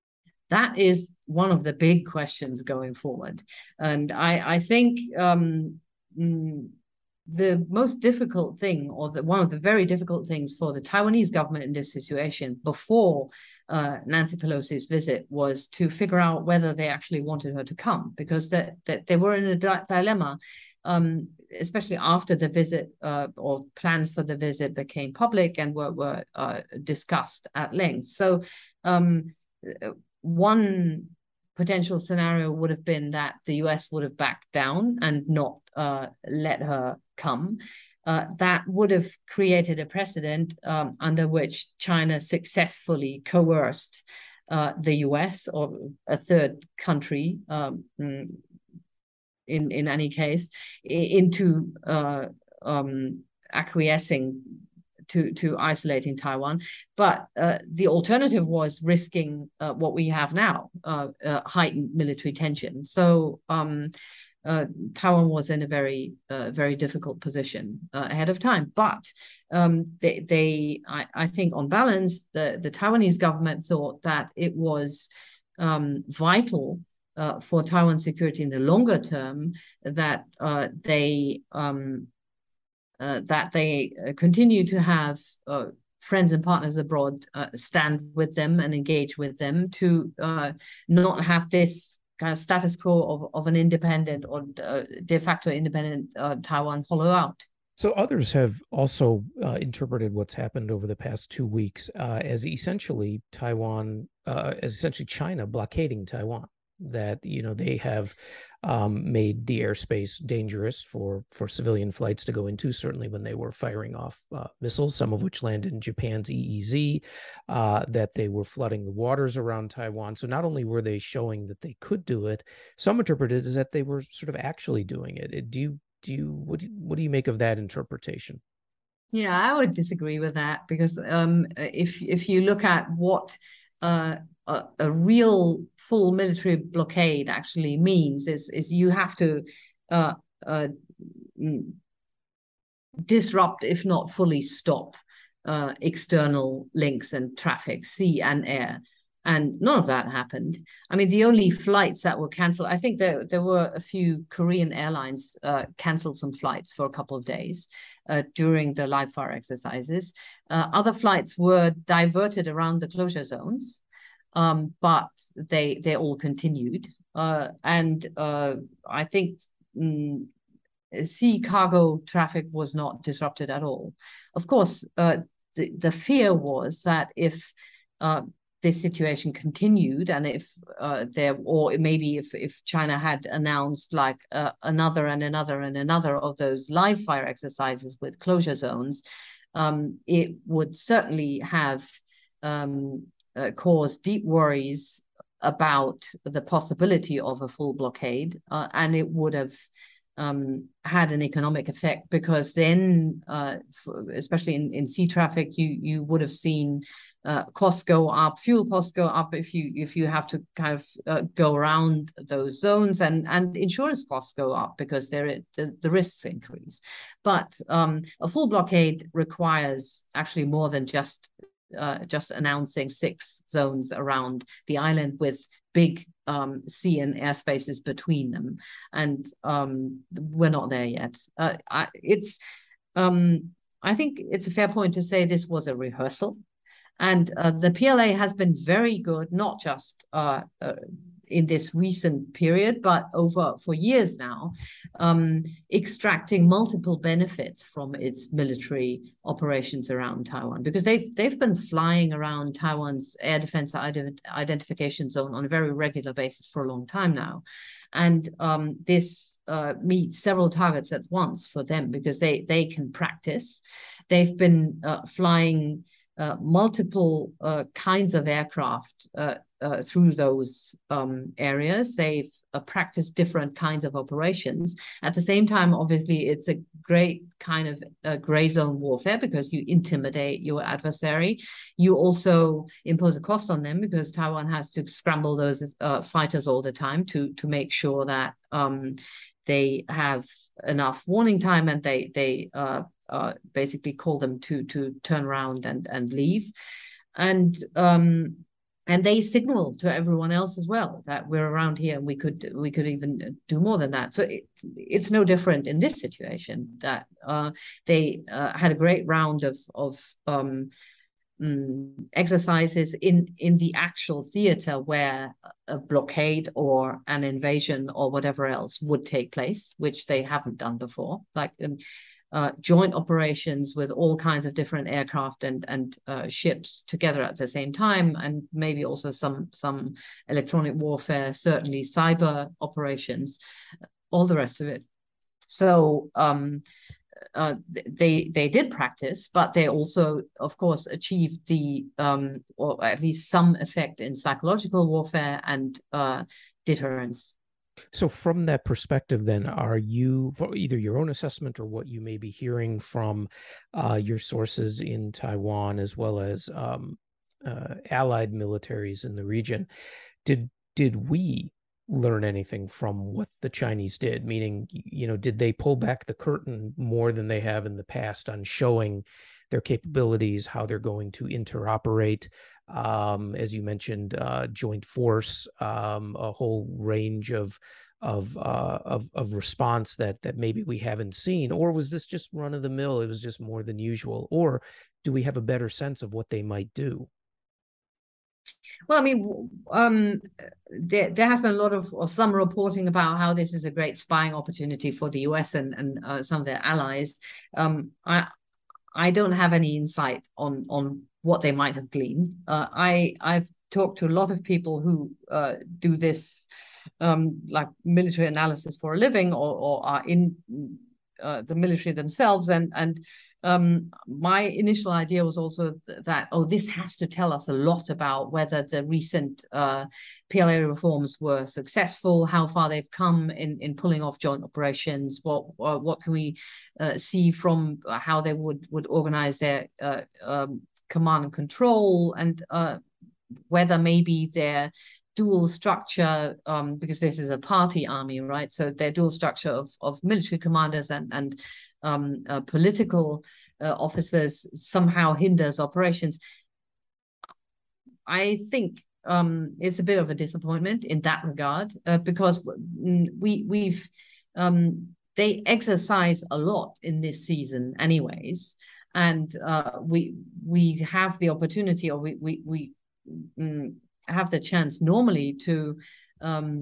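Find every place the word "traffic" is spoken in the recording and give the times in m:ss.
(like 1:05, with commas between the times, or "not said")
2:27, 2:52, 3:25.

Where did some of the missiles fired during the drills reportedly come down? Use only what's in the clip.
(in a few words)
Japan's EEZ.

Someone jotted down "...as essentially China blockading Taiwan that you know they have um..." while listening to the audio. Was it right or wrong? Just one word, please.
right.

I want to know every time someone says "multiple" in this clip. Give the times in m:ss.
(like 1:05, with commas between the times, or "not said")
4:06, 4:26.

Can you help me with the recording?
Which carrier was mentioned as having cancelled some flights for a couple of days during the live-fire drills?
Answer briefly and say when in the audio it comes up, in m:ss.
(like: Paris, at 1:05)
Korean Airlines, at 2:34.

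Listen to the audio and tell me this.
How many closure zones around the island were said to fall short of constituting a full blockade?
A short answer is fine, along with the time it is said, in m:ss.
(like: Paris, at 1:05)
6, at 3:42.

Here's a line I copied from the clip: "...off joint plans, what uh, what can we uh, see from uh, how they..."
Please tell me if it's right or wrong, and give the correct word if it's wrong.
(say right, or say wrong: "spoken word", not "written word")
wrong: "operations", not "plans".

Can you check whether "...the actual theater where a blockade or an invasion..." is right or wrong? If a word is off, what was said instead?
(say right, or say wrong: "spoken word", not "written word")
right.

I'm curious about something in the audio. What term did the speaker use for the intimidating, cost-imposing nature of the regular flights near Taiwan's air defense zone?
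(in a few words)
Gray zone warfare.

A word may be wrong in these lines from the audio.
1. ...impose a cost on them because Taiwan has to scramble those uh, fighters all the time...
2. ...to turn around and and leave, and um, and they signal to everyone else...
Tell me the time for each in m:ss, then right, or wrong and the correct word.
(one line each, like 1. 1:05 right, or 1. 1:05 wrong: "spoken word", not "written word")
1. 4:42 right
2. 4:54 right.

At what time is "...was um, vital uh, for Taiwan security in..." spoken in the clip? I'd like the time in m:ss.
1:14.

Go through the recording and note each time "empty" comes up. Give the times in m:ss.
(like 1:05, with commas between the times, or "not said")
not said.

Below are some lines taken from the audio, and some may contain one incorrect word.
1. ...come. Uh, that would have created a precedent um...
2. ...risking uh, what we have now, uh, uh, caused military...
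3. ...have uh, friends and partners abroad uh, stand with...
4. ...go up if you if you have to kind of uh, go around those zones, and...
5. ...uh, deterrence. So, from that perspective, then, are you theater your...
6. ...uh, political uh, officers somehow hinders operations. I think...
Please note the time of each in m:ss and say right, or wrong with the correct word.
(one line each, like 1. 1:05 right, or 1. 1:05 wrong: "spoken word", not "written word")
1. 0:37 right
2. 0:58 wrong: "heightened", not "caused"
3. 1:24 right
4. 3:28 right
5. 5:45 wrong: "either", not "theater"
6. 7:22 right.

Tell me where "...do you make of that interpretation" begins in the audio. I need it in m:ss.
2:06.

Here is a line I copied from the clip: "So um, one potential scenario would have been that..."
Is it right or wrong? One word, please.
right.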